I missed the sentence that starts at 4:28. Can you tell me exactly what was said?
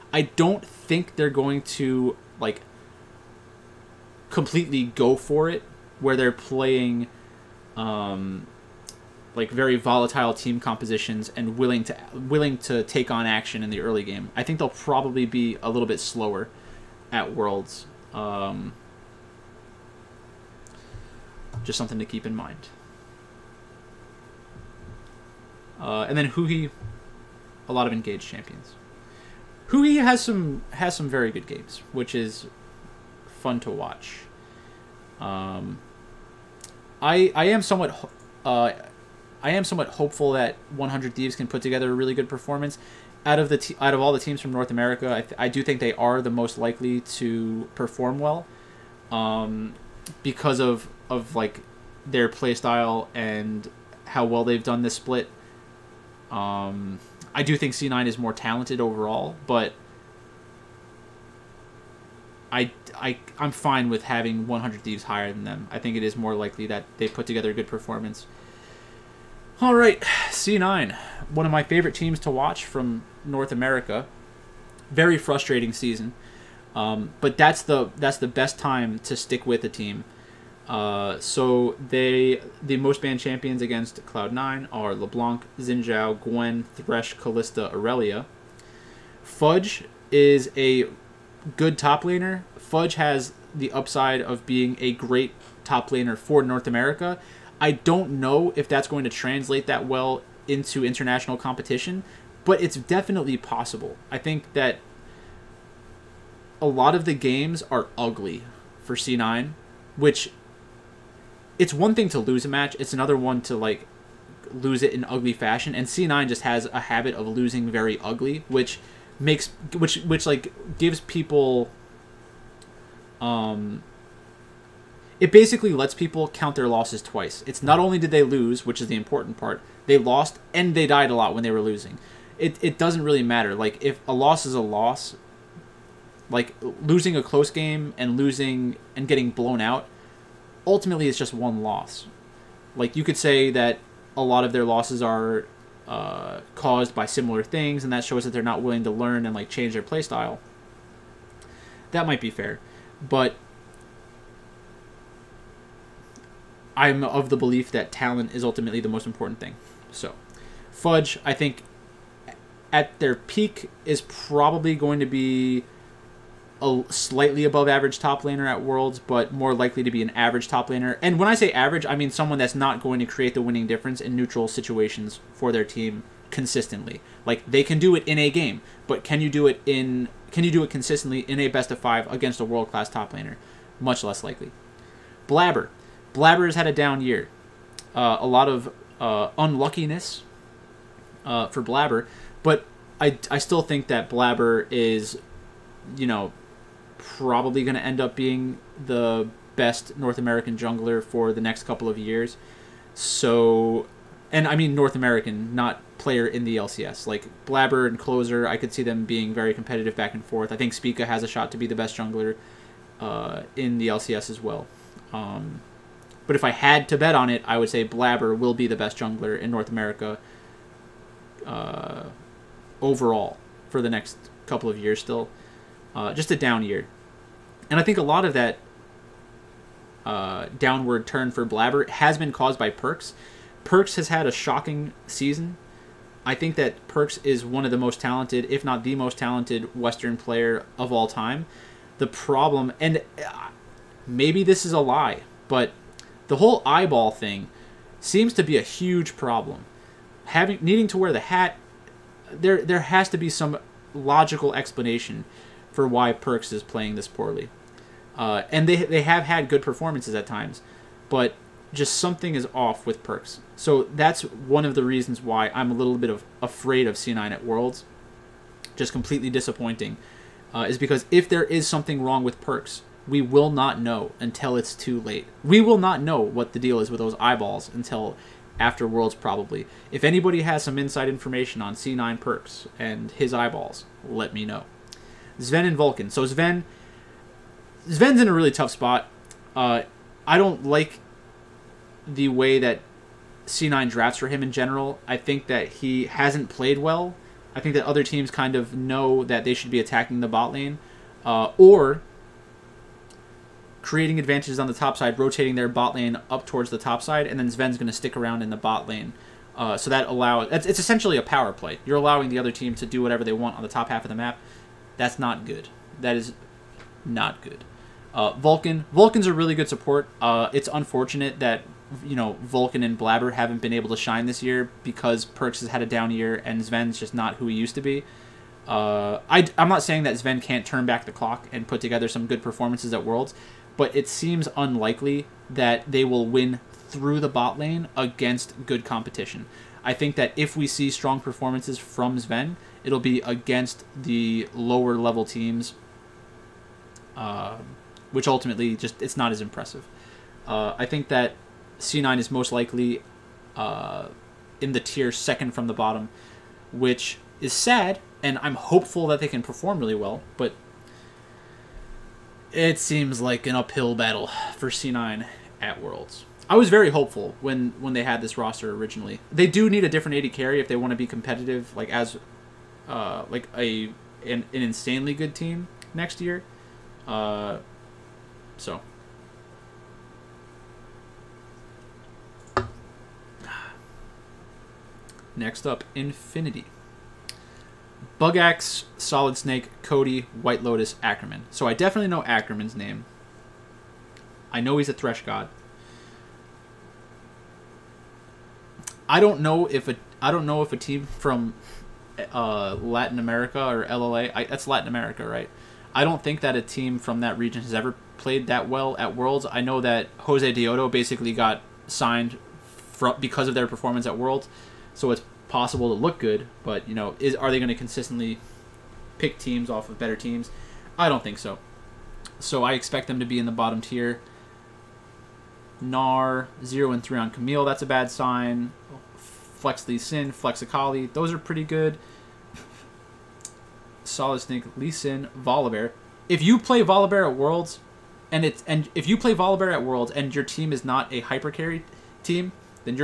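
Just completely disappointing, uh, is because if there is something wrong with Perkz, we will not know until it's too late.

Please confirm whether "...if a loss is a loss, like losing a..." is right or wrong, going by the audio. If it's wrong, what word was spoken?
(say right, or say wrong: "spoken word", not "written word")
right.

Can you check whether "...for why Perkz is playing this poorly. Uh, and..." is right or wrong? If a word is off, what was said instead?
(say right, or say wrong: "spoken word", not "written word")
right.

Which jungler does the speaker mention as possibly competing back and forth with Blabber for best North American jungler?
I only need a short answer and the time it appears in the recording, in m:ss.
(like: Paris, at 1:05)
Closer, at 3:27.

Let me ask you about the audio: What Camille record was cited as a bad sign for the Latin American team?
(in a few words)
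0 and 3.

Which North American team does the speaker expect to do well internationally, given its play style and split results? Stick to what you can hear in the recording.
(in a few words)
100 Thieves.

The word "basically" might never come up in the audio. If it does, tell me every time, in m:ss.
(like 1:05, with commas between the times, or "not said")
2:05, 6:50.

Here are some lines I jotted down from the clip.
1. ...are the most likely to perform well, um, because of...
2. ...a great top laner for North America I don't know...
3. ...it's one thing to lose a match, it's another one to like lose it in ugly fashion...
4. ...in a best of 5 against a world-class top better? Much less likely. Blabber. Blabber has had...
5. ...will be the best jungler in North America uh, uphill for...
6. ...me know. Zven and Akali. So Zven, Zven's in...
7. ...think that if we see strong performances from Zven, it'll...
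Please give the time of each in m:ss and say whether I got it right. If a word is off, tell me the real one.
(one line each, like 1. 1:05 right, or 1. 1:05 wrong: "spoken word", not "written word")
1. 0:45 right
2. 1:34 right
3. 1:51 right
4. 3:01 wrong: "laner", not "better"
5. 3:38 wrong: "overall", not "uphill"
6. 4:44 wrong: "Vulcan", not "Akali"
7. 5:39 right.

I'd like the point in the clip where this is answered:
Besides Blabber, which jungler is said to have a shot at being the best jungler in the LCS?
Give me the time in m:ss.
3:30.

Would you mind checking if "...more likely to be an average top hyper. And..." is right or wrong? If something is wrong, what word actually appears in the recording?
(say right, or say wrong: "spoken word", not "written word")
wrong: "laner", not "hyper".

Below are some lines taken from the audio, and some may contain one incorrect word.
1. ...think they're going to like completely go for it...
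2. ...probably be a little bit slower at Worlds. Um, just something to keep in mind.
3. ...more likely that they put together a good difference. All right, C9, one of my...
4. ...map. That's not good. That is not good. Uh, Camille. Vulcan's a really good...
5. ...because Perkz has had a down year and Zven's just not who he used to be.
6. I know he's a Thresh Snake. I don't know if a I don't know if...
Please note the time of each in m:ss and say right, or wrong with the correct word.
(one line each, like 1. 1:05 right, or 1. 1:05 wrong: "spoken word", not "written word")
1. 0:00 right
2. 0:14 right
3. 1:06 wrong: "performance", not "difference"
4. 5:14 wrong: "Vulcan", not "Camille"
5. 5:24 right
6. 6:34 wrong: "God", not "Snake".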